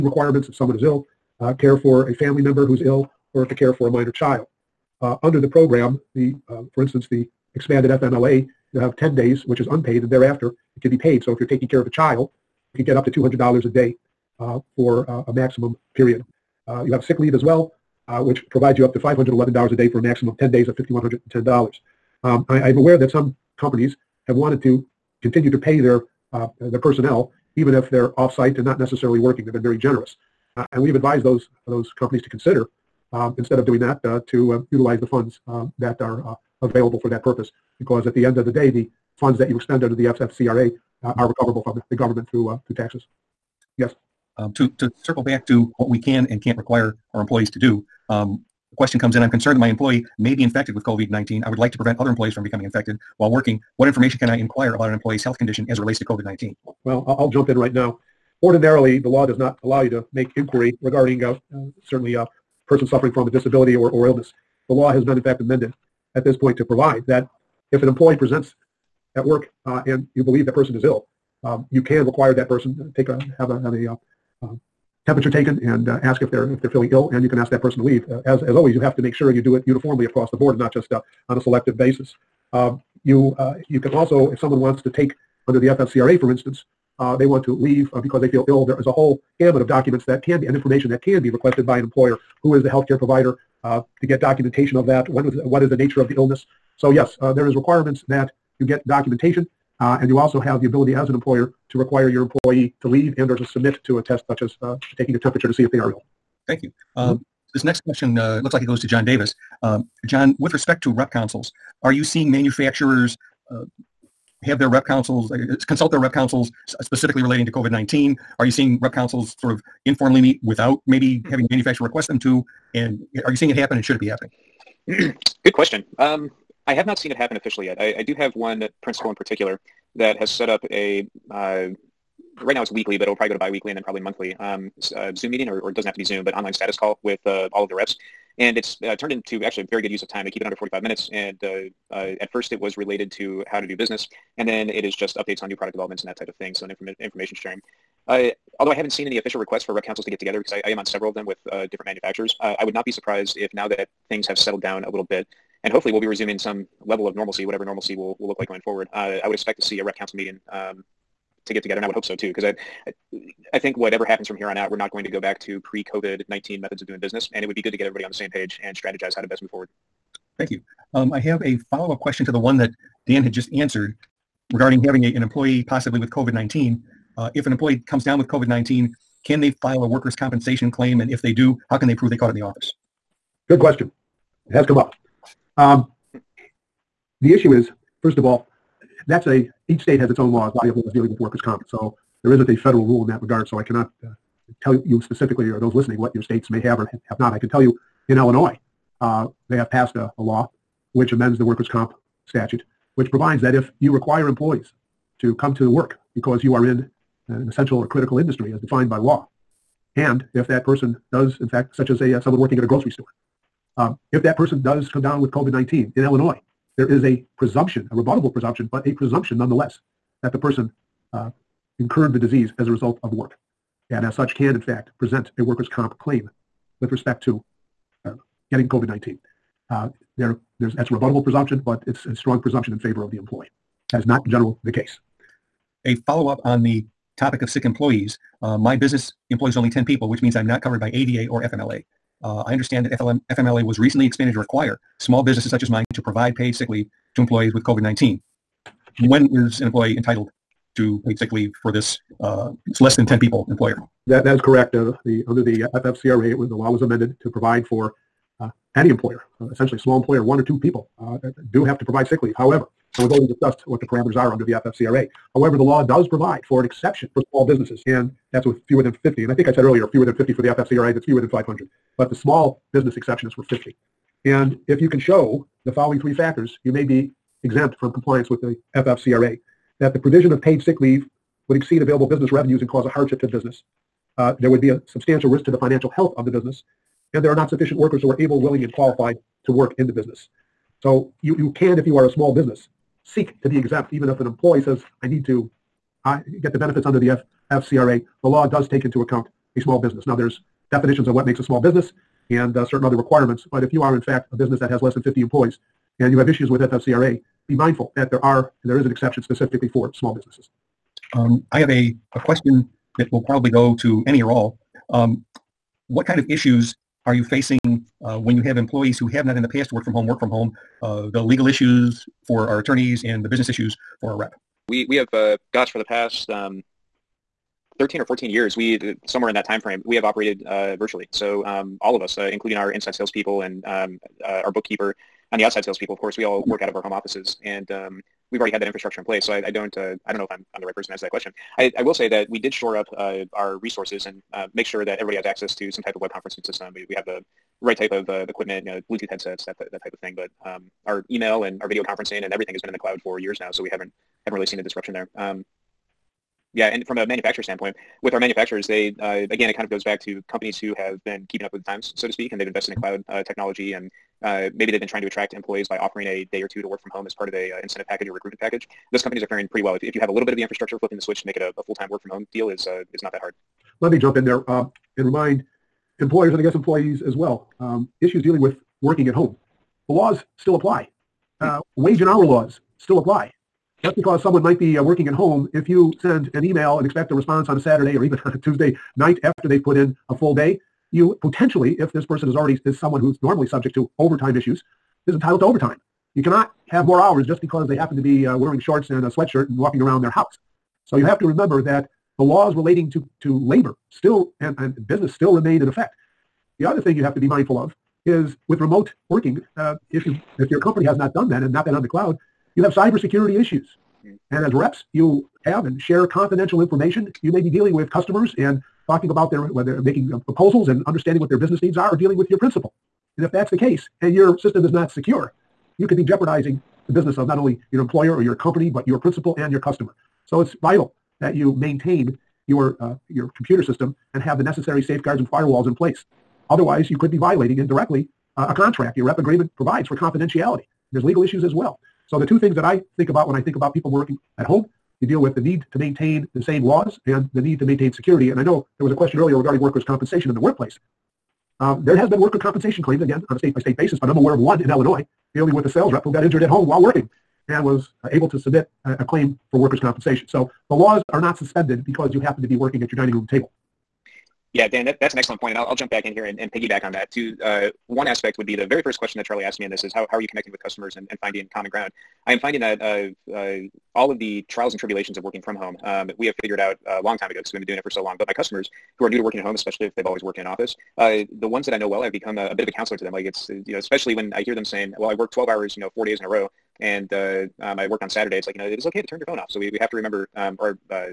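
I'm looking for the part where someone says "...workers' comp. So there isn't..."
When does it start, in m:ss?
3:11.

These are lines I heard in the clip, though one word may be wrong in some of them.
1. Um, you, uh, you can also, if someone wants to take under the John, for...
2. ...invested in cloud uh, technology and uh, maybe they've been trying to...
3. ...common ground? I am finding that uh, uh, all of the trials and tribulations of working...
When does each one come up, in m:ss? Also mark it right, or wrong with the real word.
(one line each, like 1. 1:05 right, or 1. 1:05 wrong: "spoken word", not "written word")
1. 1:22 wrong: "FFCRA", not "John"
2. 6:02 right
3. 7:51 right.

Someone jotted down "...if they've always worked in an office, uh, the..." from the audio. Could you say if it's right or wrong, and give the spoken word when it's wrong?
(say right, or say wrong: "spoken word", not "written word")
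right.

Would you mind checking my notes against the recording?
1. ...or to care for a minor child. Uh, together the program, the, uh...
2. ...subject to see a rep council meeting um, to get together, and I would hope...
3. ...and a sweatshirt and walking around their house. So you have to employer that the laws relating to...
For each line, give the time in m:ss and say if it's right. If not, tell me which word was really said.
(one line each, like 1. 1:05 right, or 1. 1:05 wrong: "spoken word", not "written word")
1. 0:03 wrong: "under", not "together"
2. 2:39 wrong: "expect", not "subject"
3. 6:38 wrong: "remember", not "employer".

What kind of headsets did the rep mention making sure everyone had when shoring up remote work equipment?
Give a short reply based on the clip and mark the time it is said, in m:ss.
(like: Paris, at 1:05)
Bluetooth headsets, at 5:48.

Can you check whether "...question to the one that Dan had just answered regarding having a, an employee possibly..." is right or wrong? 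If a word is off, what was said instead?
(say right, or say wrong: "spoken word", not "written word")
right.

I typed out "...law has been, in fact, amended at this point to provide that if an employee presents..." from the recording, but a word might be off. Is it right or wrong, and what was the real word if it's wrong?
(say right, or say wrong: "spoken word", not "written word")
right.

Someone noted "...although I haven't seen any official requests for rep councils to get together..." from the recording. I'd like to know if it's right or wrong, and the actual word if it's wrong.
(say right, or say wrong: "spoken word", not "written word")
right.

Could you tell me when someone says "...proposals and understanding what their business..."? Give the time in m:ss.
7:00.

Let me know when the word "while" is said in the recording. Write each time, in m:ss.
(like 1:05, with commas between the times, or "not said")
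0:53, 7:36.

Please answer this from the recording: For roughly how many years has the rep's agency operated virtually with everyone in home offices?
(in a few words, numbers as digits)
13 or 14 years.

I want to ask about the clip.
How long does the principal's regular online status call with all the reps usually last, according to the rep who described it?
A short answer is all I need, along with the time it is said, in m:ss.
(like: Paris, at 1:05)
under 45 minutes, at 2:20.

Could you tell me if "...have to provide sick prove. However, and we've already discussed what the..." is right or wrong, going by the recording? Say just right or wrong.
wrong.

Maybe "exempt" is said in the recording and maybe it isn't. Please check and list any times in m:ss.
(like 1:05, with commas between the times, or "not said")
4:37, 4:53.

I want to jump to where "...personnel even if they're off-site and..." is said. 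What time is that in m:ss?
0:26.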